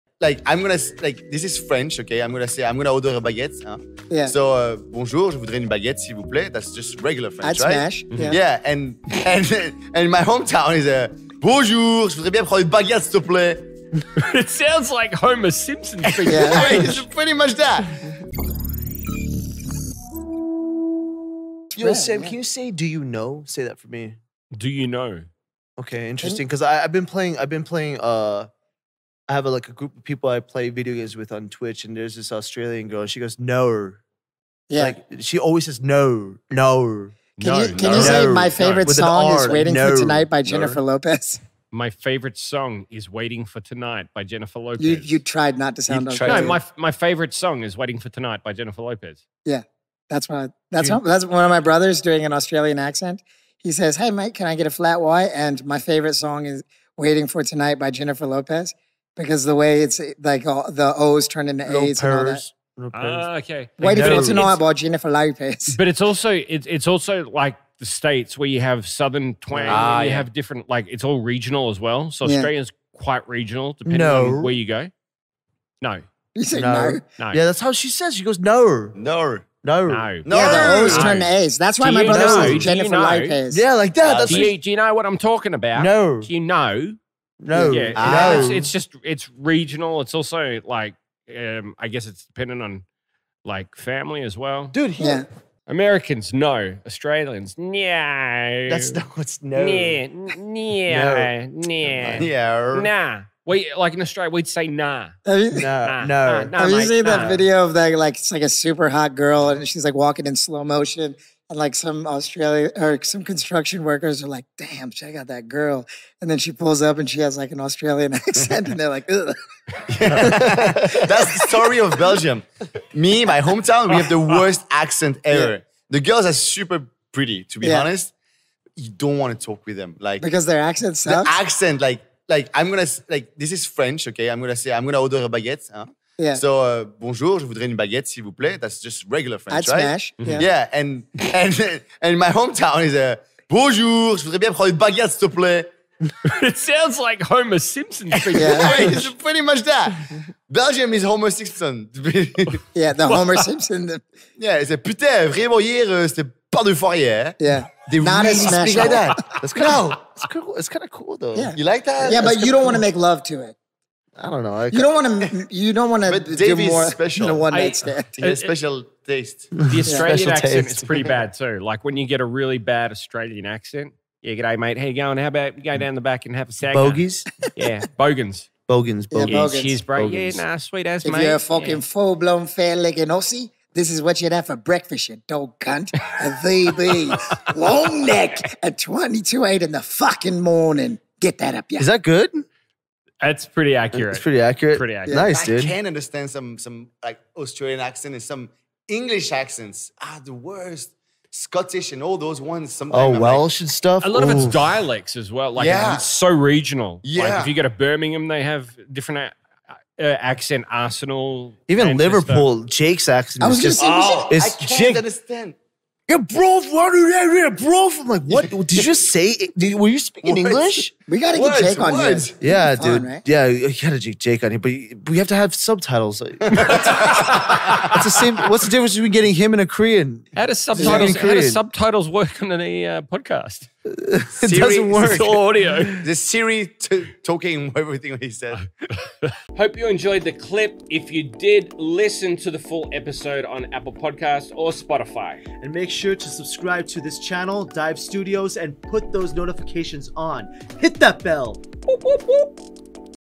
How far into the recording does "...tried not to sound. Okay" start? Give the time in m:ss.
0:45.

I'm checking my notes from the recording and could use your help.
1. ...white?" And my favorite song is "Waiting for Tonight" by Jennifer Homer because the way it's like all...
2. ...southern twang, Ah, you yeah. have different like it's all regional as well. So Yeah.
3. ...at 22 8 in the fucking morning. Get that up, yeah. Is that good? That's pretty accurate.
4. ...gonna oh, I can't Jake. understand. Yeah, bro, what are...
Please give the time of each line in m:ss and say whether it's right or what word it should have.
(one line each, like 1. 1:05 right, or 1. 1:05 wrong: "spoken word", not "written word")
1. 0:55 wrong: "Lopez", not "Homer"
2. 1:08 right
3. 3:08 right
4. 3:33 right.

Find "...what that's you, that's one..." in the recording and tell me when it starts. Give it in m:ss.
0:50.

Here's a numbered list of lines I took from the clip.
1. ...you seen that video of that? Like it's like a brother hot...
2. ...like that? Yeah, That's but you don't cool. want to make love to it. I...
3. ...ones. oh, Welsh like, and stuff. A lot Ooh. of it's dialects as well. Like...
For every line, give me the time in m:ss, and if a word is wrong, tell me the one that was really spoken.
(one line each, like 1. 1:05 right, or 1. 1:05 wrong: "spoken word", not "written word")
1. 1:46 wrong: "super", not "brother"
2. 2:41 right
3. 3:22 right.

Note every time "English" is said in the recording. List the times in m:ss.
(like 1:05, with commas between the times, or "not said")
3:18, 3:40.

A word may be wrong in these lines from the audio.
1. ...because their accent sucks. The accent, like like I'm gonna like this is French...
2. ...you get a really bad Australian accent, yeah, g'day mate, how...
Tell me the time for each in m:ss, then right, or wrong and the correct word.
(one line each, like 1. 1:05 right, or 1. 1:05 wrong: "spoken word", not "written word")
1. 2:10 right
2. 2:51 right.